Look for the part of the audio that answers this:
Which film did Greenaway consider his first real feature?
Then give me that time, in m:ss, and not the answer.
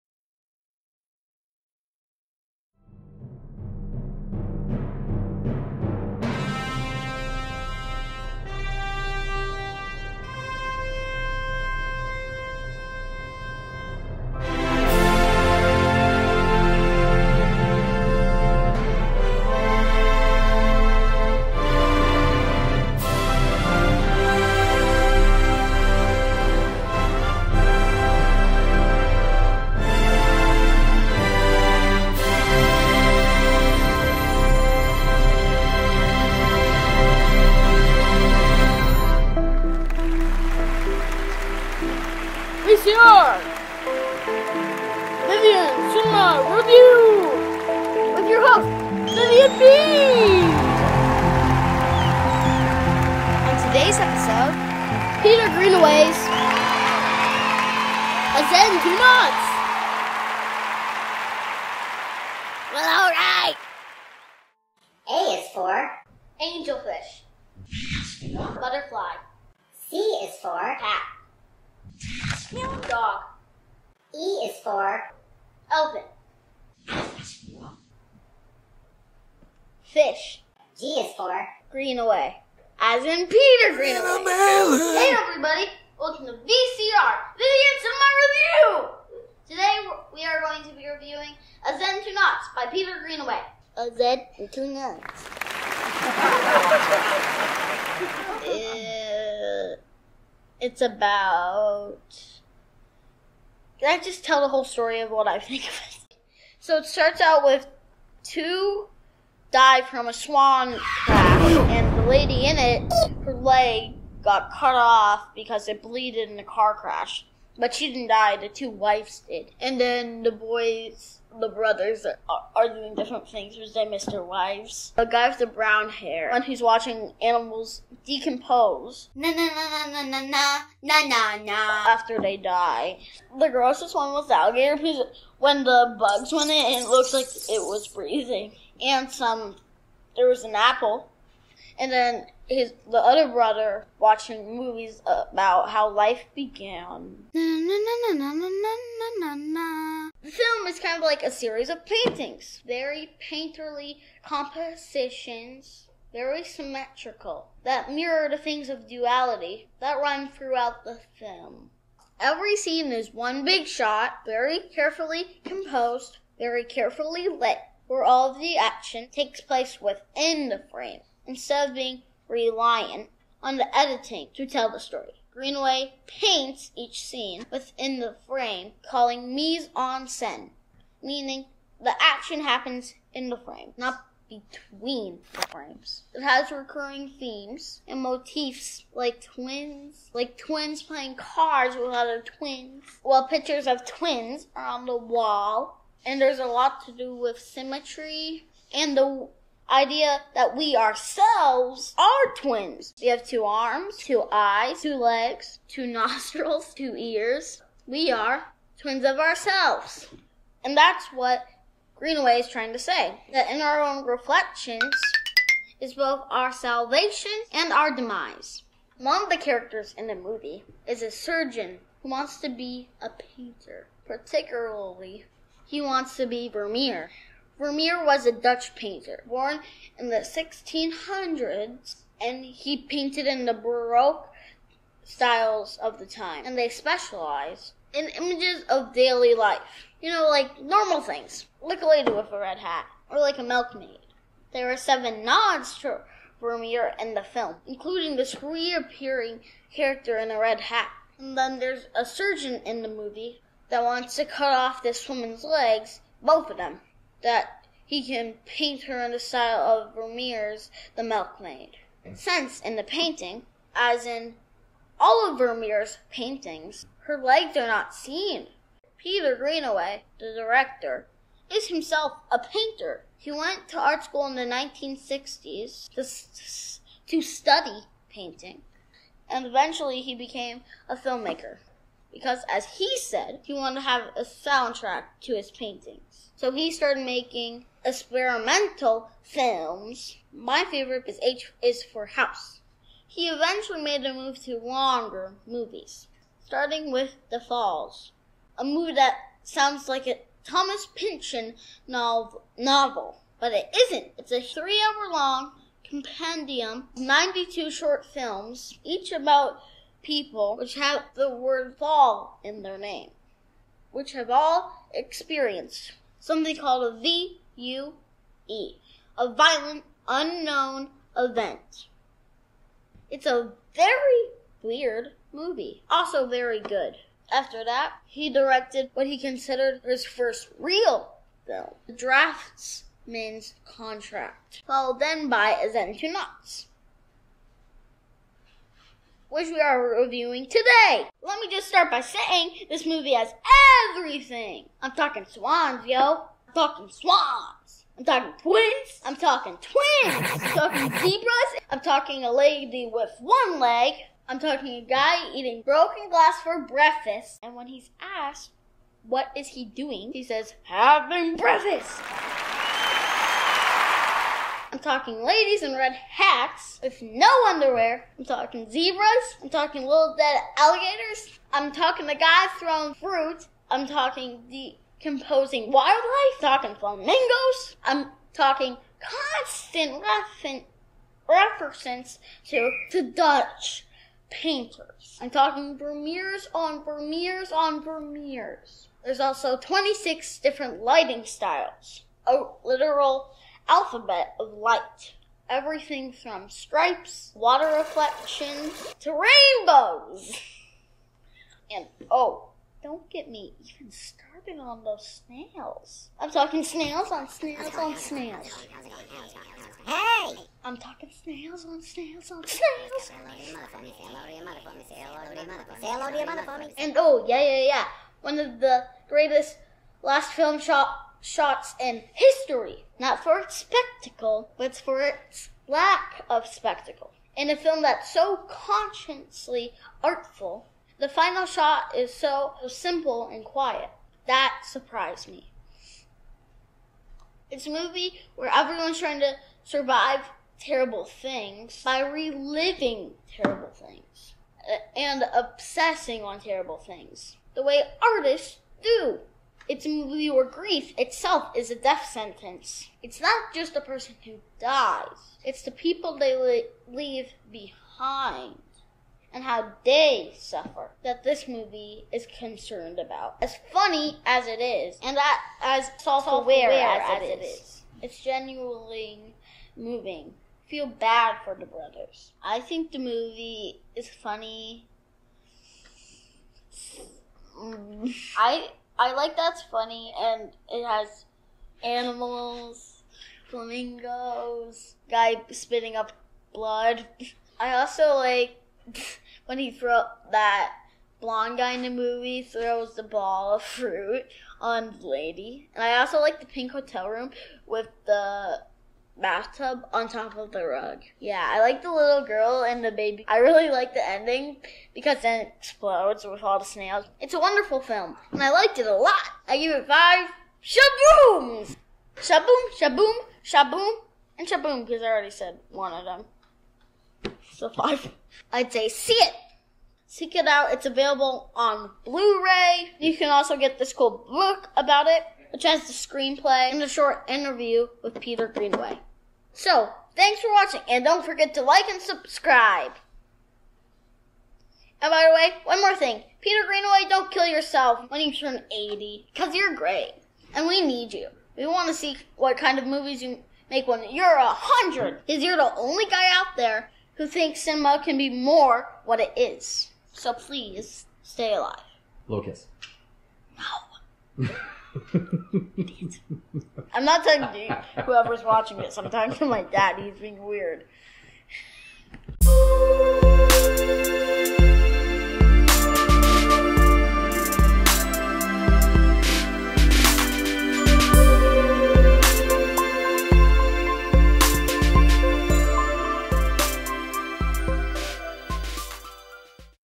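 5:31.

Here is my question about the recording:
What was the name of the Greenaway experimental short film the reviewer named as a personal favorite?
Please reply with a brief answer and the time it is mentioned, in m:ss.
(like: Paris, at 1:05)
H is for House, at 4:51.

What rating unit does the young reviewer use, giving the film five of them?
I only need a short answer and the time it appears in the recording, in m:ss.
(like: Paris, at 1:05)
shabooms, at 8:30.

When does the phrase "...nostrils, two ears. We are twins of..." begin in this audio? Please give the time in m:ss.
3:25.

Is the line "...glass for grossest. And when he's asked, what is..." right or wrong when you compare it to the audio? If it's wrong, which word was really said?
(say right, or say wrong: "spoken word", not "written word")
wrong: "breakfast", not "grossest".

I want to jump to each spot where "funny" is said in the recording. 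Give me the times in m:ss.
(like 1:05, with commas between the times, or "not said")
7:43, 7:54, 7:59.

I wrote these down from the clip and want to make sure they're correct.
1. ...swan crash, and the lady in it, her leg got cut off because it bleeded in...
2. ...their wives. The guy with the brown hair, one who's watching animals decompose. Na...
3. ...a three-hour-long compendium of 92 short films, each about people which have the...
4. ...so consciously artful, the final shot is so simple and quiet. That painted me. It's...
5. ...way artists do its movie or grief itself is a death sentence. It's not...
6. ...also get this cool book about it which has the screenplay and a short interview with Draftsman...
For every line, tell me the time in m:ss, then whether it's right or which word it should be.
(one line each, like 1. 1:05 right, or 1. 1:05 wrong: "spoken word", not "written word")
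1. 1:50 right
2. 2:04 right
3. 5:04 right
4. 7:08 wrong: "surprised", not "painted"
5. 7:27 right
6. 8:43 wrong: "Peter", not "Draftsman".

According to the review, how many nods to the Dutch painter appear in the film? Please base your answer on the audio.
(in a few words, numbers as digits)
7.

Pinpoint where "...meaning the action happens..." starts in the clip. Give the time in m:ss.
3:01.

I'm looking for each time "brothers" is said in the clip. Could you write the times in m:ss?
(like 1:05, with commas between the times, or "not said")
2:01, 2:23, 7:51.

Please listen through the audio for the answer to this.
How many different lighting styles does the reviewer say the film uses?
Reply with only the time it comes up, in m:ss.
6:29.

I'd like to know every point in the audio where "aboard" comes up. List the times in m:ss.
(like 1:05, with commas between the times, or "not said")
not said.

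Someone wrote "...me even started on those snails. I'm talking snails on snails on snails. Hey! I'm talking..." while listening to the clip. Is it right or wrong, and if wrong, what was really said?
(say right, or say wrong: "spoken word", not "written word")
right.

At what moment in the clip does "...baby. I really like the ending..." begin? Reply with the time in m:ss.
8:22.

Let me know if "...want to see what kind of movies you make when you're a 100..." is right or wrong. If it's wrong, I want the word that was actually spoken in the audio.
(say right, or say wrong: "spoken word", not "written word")
right.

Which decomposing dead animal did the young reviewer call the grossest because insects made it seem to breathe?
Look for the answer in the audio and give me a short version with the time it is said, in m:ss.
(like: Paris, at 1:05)
alligator, at 2:14.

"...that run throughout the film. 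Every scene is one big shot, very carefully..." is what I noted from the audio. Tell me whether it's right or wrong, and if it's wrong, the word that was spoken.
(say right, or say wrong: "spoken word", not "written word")
right.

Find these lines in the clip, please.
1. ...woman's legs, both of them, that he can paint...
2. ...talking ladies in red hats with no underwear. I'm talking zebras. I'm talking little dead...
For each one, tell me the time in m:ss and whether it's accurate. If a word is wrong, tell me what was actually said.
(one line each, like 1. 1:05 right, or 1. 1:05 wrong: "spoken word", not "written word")
1. 4:15 right
2. 6:04 right.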